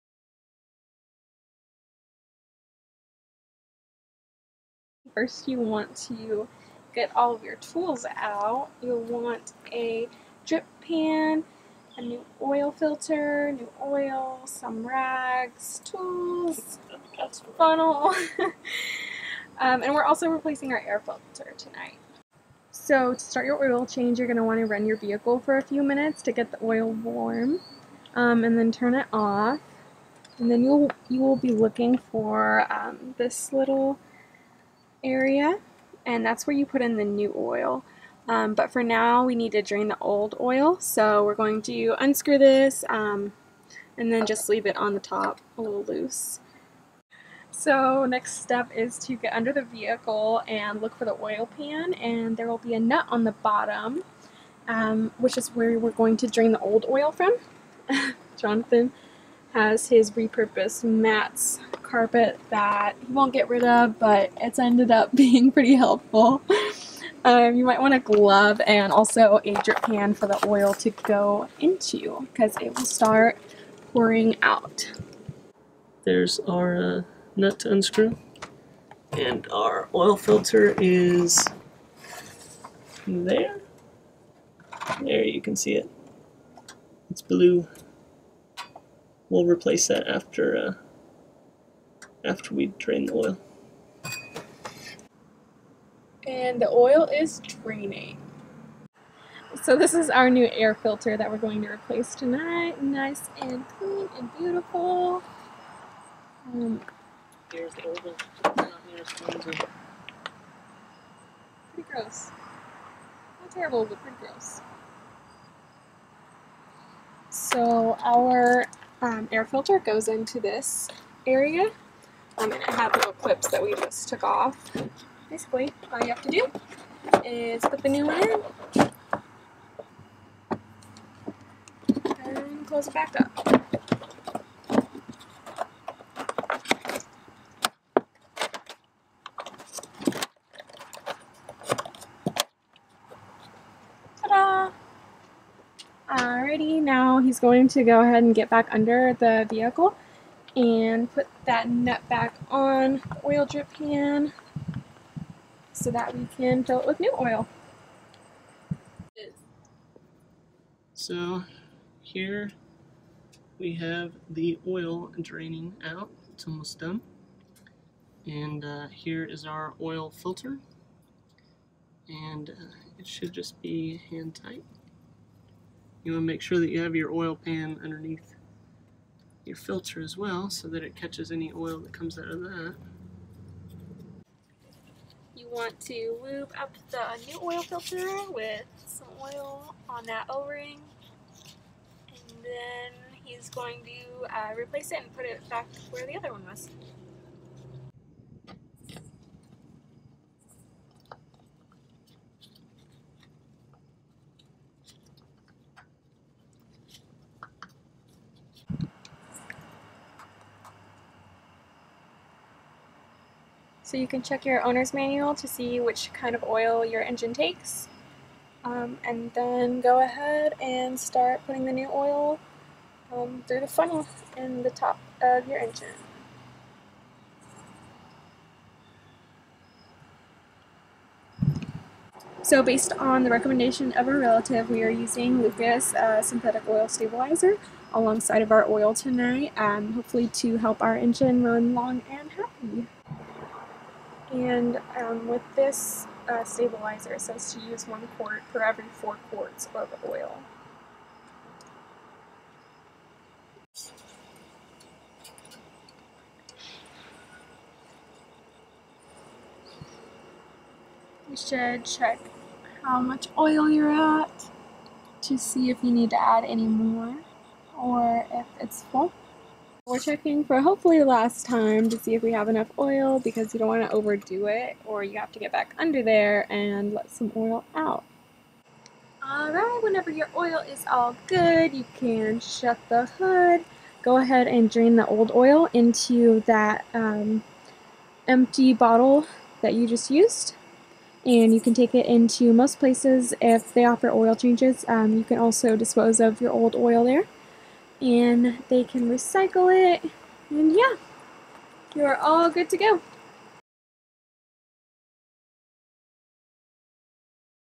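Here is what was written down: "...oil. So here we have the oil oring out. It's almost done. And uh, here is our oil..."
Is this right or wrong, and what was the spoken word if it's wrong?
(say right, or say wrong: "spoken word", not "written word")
wrong: "draining", not "oring".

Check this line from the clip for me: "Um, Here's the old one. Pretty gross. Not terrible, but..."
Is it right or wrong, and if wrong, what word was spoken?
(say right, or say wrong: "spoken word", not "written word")
right.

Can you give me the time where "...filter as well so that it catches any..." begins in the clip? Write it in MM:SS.
02:59.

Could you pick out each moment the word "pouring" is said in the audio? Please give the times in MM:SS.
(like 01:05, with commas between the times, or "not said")
01:13.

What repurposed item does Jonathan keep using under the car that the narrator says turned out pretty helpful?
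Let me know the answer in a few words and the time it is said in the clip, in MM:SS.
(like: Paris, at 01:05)
Carpet, at 01:00.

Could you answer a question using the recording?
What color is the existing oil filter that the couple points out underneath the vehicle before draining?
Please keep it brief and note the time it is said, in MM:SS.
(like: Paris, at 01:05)
Blue, at 01:27.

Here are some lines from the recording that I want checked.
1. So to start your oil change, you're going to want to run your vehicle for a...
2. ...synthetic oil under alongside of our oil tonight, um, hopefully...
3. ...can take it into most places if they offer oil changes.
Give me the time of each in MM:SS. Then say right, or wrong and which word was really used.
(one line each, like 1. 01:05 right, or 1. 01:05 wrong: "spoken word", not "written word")
1. 00:22 right
2. 03:56 wrong: "stabilizer", not "under"
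3. 04:51 right.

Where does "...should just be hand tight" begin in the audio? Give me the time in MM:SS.
02:53.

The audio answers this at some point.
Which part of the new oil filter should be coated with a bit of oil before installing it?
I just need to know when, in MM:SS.
03:10.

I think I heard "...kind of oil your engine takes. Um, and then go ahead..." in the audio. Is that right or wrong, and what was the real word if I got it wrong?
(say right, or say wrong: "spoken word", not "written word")
right.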